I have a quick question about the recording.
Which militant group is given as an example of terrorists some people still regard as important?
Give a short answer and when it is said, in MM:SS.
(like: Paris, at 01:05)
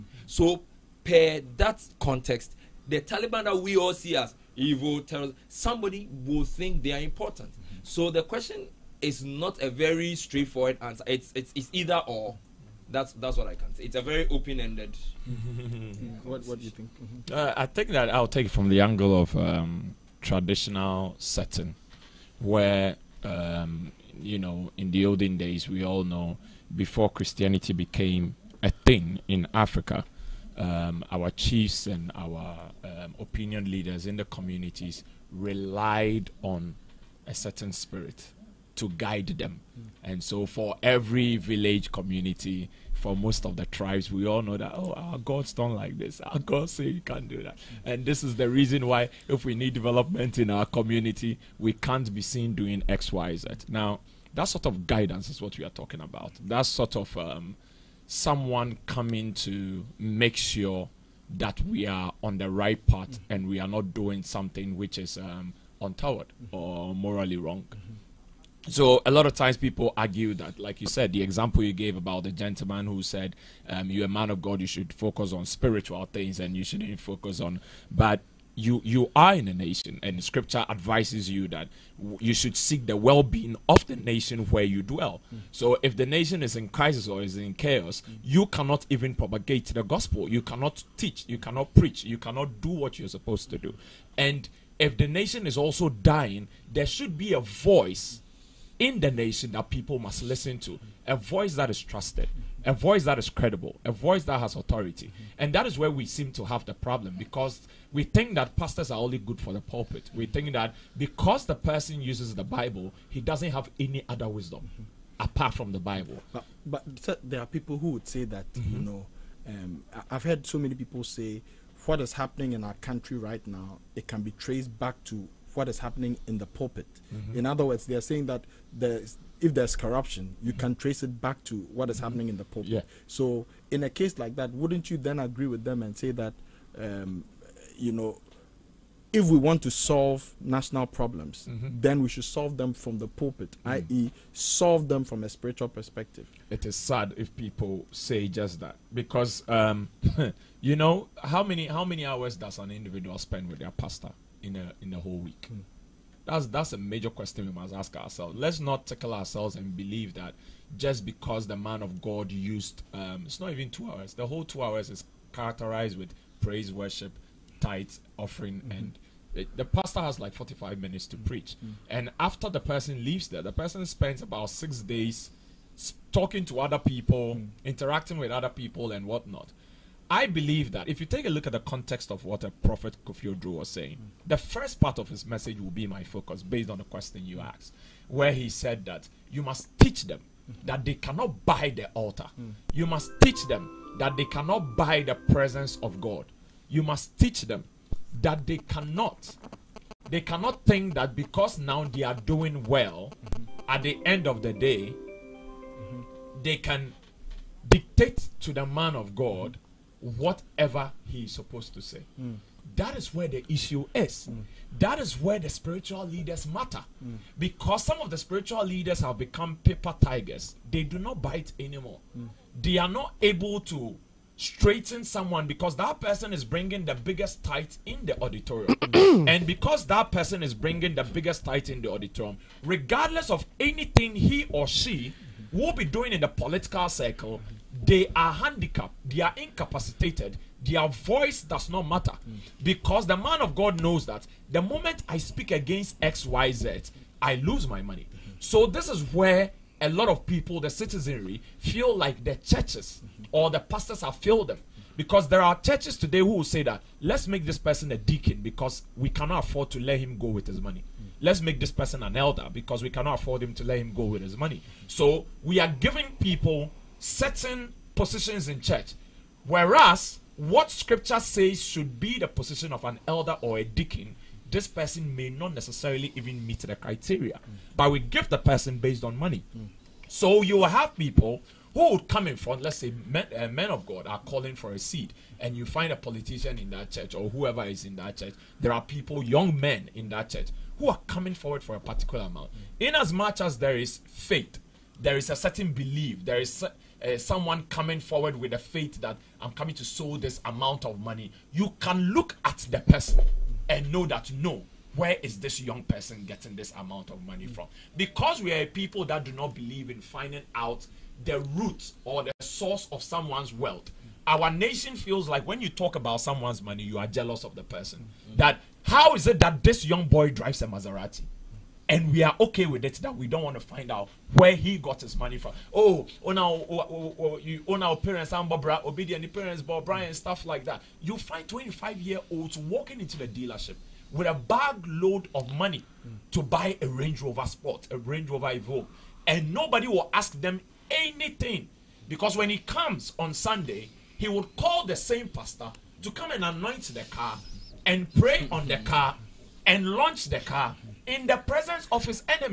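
Taliban, at 00:03.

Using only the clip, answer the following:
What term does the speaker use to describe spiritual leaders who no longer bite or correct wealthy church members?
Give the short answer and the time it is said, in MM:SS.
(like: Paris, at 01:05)
paper tigers, at 03:39.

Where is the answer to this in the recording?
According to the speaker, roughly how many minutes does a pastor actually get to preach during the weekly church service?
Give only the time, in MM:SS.
02:50.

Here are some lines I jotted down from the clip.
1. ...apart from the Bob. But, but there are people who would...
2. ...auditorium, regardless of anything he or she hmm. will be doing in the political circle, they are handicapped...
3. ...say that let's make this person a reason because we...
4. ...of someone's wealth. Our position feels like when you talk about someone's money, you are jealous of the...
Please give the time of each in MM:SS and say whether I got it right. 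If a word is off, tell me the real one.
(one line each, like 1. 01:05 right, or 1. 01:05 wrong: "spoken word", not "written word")
1. 01:55 wrong: "Bible", not "Bob"
2. 03:51 right
3. 04:16 wrong: "deacon", not "reason"
4. 05:12 wrong: "nation", not "position".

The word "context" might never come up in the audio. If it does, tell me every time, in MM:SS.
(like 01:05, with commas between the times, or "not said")
00:01, 03:01.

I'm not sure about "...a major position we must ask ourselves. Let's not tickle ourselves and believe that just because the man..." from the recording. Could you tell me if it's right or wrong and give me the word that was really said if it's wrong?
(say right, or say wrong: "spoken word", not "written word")
wrong: "question", not "position".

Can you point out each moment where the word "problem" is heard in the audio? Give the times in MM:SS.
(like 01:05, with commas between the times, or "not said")
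01:46, 02:20.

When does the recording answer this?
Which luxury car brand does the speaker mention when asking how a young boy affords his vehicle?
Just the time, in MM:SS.
05:20.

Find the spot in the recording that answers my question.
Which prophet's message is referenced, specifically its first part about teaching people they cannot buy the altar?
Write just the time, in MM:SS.
03:03.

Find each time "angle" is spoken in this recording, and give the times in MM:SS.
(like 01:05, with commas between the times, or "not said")
00:18.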